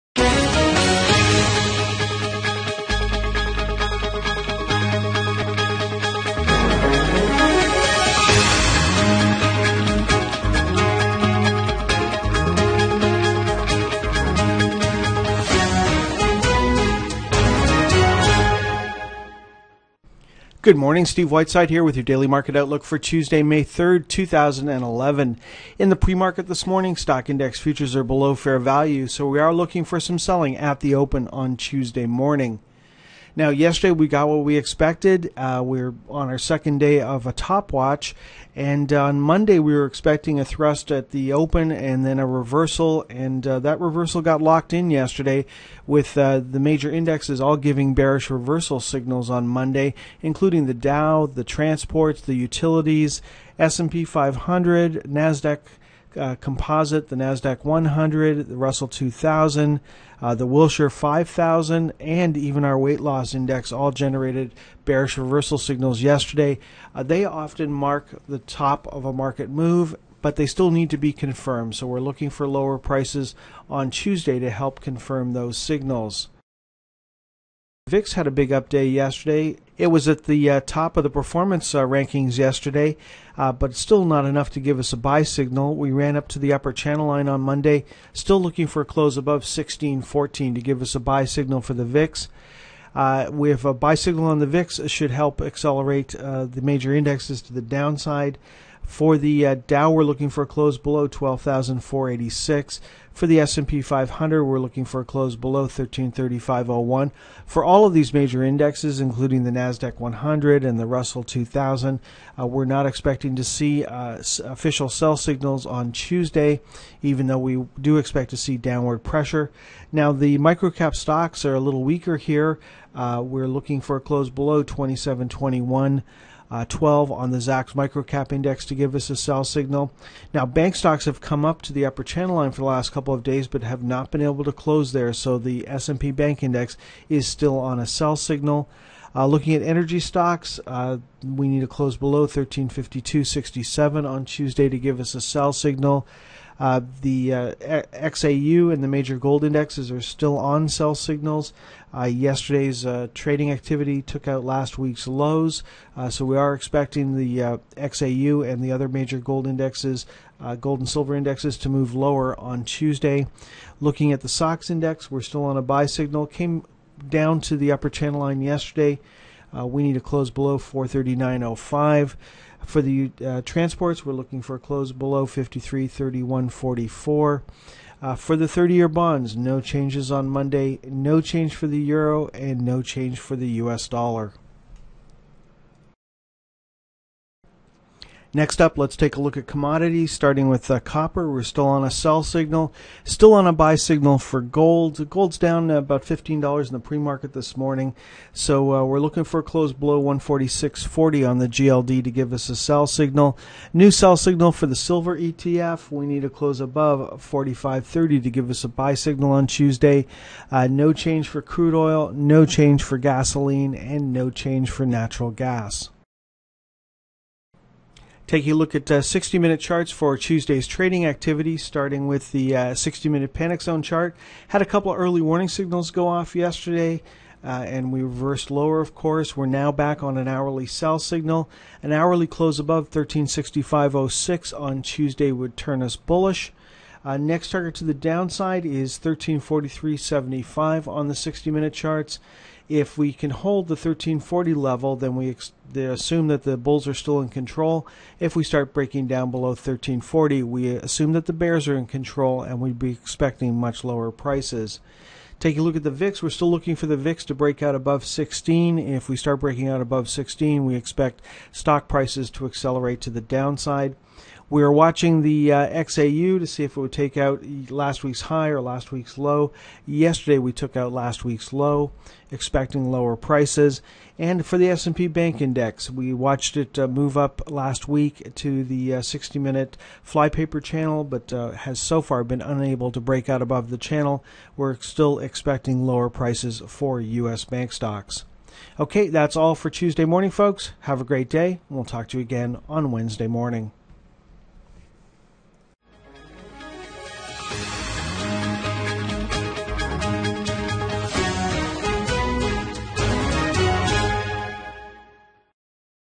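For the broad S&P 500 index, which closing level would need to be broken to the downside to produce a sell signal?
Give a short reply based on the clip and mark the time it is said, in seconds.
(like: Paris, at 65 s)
1335.01, at 105 s.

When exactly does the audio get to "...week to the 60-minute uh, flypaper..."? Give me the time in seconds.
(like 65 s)
277 s.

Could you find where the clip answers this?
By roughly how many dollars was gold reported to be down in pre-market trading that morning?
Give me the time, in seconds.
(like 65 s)
196 s.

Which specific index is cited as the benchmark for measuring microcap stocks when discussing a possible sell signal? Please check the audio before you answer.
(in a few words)
Zacks Microcap Index.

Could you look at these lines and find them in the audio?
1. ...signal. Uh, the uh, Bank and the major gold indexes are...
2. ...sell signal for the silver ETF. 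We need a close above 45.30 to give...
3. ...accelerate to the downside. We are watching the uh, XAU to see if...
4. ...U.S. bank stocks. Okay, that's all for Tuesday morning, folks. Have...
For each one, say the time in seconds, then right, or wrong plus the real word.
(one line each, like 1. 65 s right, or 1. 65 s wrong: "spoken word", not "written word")
1. 145 s wrong: "XAU", not "Bank"
2. 203 s right
3. 262 s right
4. 286 s right.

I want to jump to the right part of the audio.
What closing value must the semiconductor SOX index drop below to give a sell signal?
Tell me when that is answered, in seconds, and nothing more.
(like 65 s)
170 s.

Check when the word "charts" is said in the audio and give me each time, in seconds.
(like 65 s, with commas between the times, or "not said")
219 s, 223 s, 241 s.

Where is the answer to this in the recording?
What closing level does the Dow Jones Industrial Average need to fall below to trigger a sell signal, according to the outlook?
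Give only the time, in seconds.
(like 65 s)
101 s.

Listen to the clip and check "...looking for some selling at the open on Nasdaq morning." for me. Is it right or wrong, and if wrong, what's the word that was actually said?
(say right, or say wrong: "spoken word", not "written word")
wrong: "Tuesday", not "Nasdaq".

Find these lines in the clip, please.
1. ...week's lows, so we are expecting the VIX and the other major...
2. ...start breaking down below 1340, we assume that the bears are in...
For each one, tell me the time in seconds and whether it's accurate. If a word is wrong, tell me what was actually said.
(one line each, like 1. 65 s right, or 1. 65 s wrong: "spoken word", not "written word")
1. 154 s wrong: "XAU", not "VIX"
2. 248 s right.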